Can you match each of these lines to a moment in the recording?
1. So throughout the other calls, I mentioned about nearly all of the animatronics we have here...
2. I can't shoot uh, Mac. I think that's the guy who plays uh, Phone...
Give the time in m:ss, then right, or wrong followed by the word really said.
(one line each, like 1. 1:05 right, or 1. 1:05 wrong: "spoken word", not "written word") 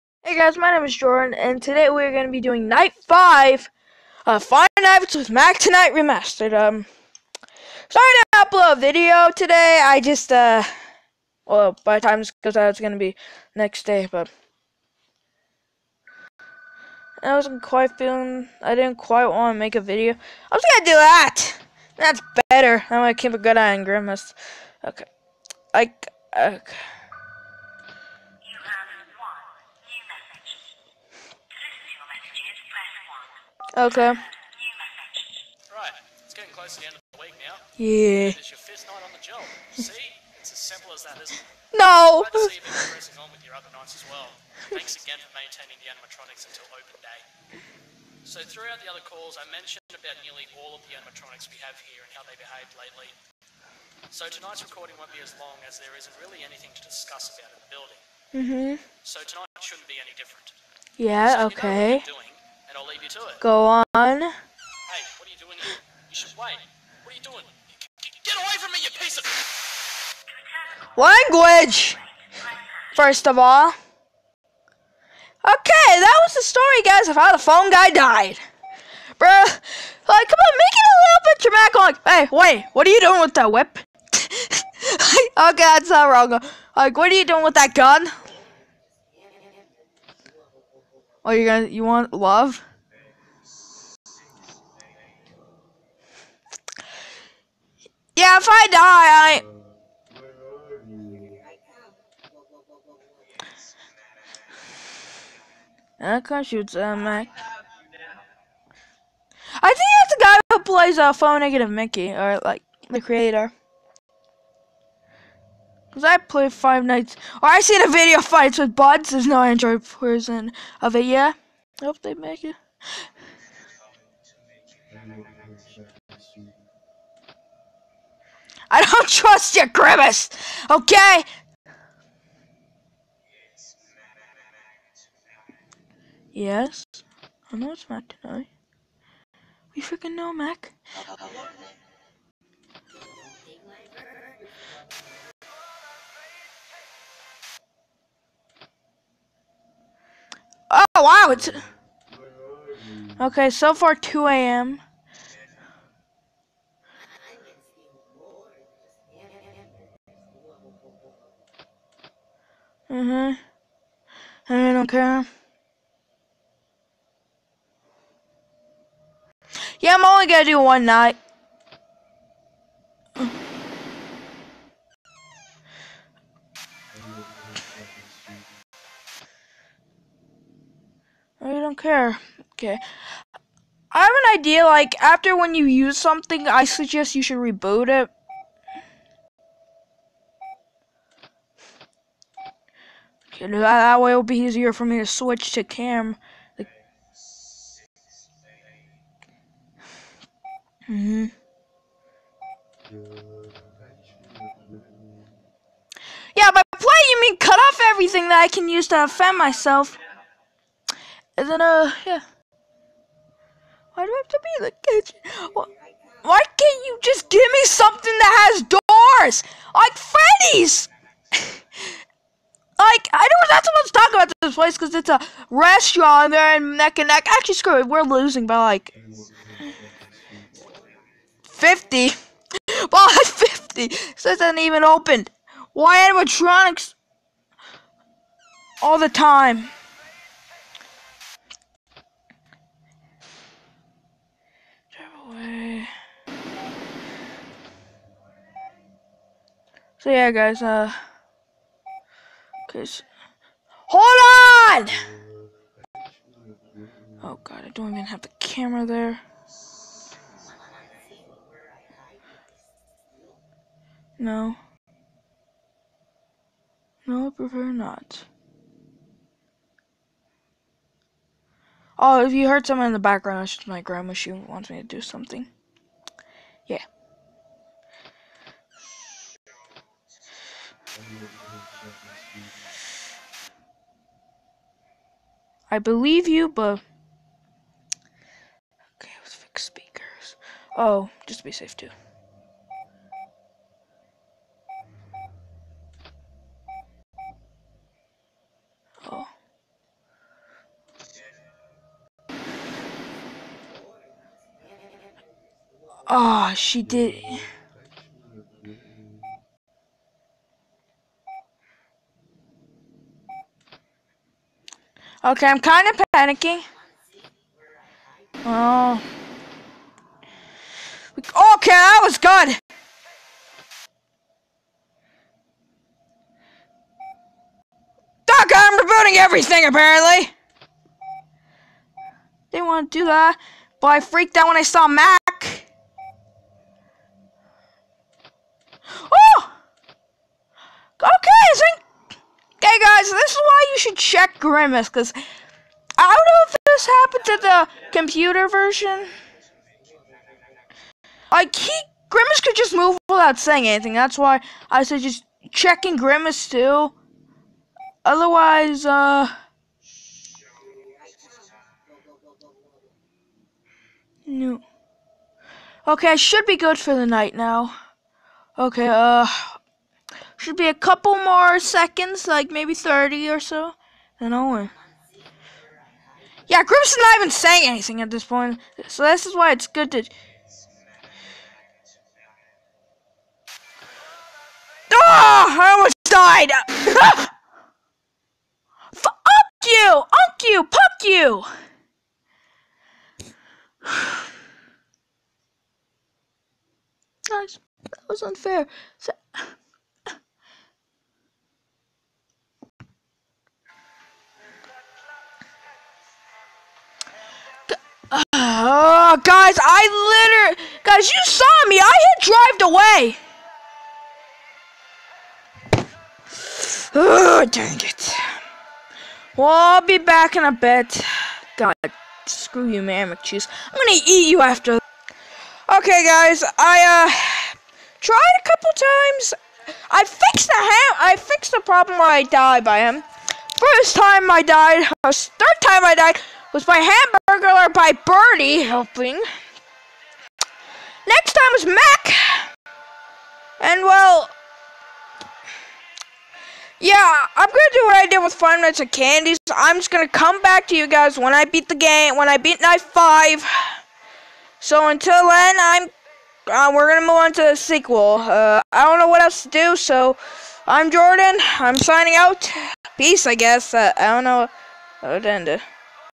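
1. 0:48 right
2. 1:46 right.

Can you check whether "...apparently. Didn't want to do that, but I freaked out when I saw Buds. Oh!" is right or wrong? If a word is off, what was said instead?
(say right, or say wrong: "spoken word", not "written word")
wrong: "Mac", not "Buds".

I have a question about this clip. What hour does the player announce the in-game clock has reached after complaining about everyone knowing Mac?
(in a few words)
2 a.m.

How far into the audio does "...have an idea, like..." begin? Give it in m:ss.
3:03.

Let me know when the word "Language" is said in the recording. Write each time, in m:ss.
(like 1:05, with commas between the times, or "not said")
1:10.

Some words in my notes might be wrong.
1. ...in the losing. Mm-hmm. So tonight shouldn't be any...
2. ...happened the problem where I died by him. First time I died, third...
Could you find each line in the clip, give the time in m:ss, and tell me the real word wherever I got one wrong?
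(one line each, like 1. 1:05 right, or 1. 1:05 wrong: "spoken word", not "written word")
1. 0:57 wrong: "building", not "losing"
2. 7:11 wrong: "fixed", not "happened".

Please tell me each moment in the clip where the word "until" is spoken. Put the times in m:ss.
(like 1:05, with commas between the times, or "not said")
0:46, 7:34.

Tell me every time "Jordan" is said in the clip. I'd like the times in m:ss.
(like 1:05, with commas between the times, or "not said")
0:00, 7:40.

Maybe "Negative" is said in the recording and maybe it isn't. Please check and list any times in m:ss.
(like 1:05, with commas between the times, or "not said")
1:51.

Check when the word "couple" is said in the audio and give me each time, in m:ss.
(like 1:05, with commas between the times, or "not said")
6:10, 7:08.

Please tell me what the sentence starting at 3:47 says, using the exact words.
Actually, screw it, we're losing by like 50.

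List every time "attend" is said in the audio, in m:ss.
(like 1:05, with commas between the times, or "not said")
not said.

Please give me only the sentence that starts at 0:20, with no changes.
I was going to do that!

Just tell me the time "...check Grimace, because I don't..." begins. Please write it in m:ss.
5:43.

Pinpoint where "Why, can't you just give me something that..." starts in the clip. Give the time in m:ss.
3:35.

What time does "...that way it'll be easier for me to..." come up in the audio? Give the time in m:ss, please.
3:13.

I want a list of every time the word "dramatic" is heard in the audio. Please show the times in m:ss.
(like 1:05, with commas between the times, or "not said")
1:21.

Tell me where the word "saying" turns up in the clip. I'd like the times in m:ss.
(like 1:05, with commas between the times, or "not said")
5:53, 6:17.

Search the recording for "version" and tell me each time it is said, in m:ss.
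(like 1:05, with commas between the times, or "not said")
1:59, 5:48.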